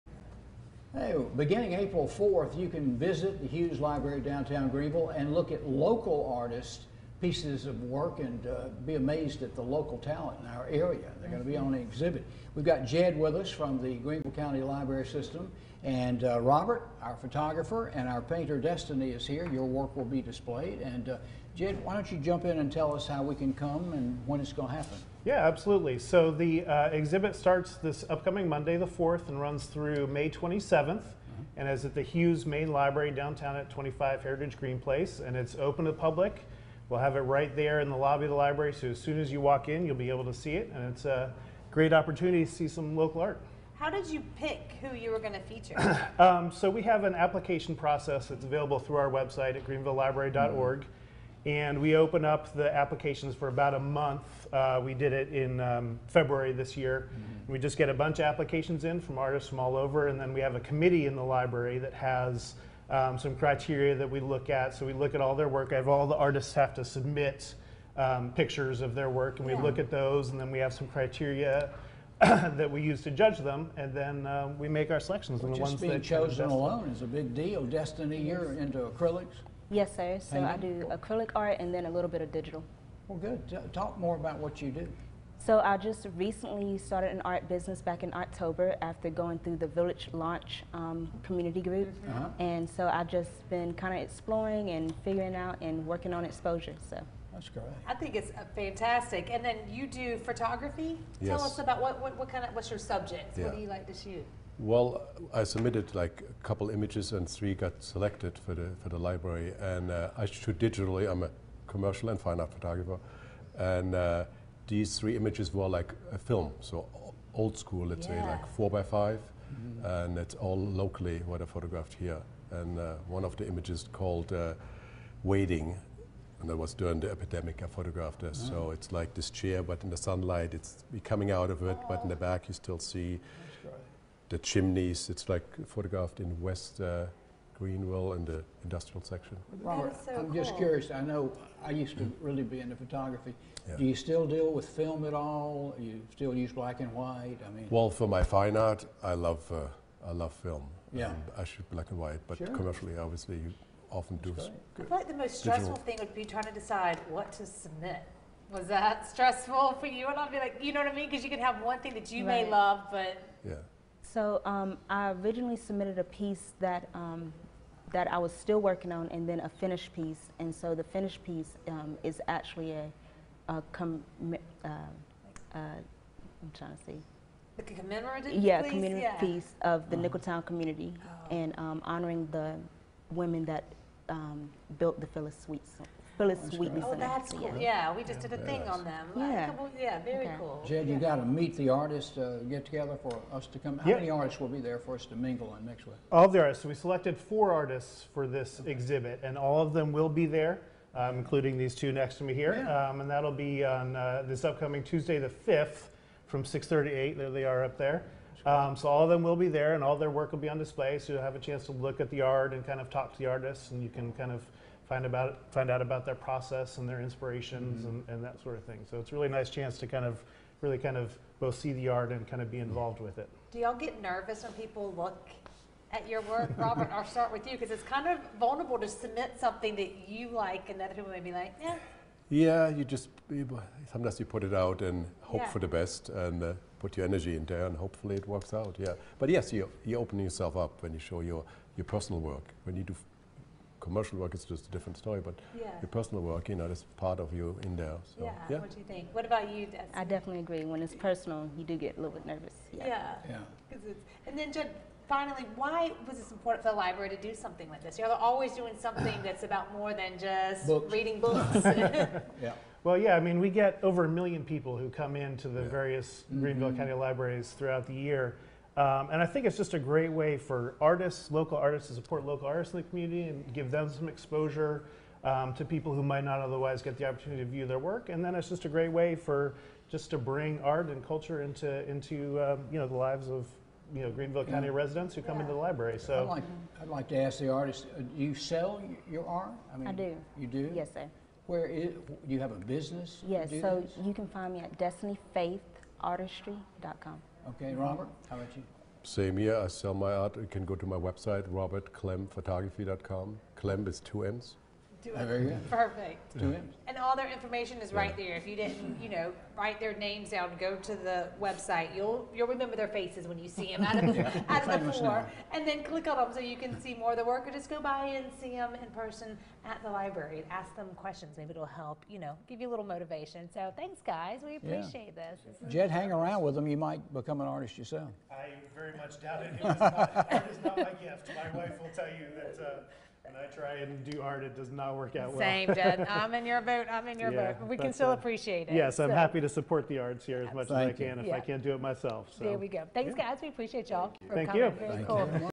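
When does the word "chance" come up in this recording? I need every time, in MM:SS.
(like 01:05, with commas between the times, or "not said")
03:31, 03:39.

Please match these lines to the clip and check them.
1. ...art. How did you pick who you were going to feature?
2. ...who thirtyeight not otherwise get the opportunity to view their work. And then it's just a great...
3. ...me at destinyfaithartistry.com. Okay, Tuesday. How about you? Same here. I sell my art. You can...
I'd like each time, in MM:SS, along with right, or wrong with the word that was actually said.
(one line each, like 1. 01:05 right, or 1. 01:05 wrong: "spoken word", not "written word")
1. 00:43 right
2. 04:35 wrong: "might", not "thirtyeight"
3. 04:54 wrong: "Robert", not "Tuesday".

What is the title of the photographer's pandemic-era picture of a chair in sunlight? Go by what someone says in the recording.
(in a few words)
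Waiting.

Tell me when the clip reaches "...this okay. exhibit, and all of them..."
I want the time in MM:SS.
03:18.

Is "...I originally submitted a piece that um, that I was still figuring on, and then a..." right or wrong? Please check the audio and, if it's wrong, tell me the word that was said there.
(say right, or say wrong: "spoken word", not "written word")
wrong: "working", not "figuring".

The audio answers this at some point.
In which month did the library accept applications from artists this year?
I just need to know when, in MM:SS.
00:56.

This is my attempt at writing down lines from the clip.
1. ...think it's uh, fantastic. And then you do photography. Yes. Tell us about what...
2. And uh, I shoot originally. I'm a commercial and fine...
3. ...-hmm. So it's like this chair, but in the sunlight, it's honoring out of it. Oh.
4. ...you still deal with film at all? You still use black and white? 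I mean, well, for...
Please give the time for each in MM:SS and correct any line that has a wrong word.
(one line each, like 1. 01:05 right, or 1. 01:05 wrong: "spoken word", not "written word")
1. 01:37 right
2. 01:49 wrong: "digitally", not "originally"
3. 02:08 wrong: "coming", not "honoring"
4. 02:23 right.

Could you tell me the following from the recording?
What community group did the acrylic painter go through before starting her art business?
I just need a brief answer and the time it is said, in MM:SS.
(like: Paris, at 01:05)
Village Launch, at 01:29.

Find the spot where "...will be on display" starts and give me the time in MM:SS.
03:30.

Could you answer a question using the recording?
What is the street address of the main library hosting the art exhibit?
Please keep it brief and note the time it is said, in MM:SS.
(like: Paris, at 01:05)
25 Heritage Green Place, at 00:33.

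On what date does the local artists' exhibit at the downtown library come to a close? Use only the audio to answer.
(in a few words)
May 27th.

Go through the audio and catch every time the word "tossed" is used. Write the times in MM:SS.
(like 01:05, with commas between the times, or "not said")
not said.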